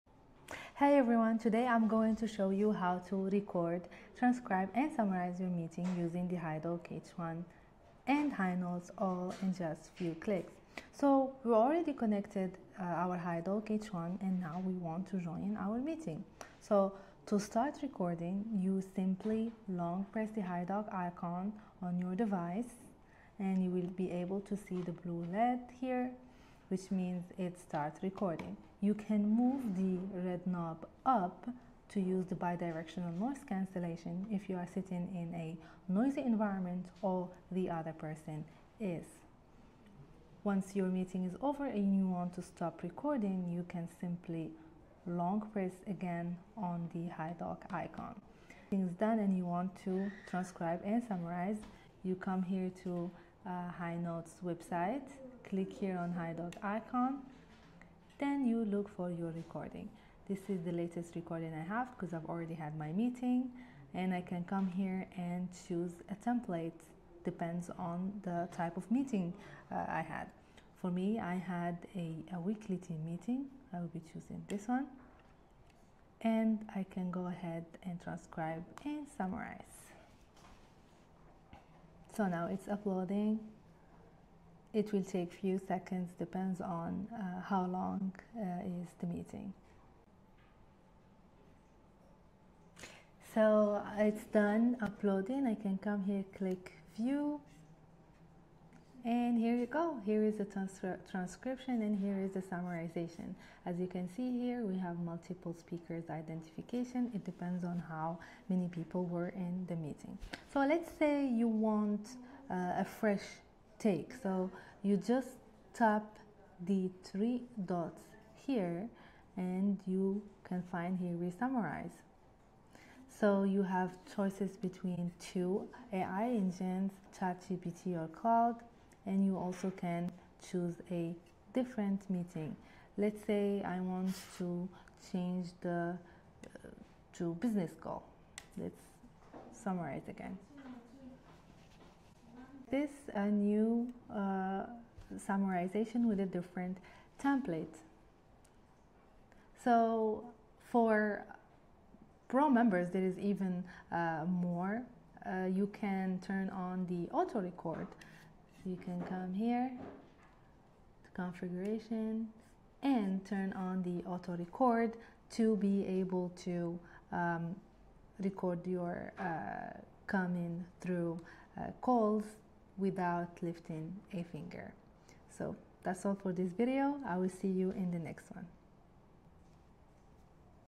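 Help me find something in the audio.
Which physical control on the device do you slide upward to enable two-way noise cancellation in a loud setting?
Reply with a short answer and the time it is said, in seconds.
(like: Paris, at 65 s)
Red knob, at 30 s.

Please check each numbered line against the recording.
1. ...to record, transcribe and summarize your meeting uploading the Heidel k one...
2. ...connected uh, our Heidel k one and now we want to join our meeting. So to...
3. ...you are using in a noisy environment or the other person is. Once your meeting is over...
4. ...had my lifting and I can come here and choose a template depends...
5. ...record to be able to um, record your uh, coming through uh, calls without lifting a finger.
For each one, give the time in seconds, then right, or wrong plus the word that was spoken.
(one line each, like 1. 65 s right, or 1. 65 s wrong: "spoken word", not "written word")
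1. 3 s wrong: "using", not "uploading"
2. 11 s right
3. 34 s wrong: "sitting", not "using"
4. 62 s wrong: "meeting", not "lifting"
5. 164 s right.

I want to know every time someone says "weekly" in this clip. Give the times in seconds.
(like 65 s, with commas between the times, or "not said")
72 s.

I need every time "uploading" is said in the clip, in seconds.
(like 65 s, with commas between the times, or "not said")
82 s, 94 s.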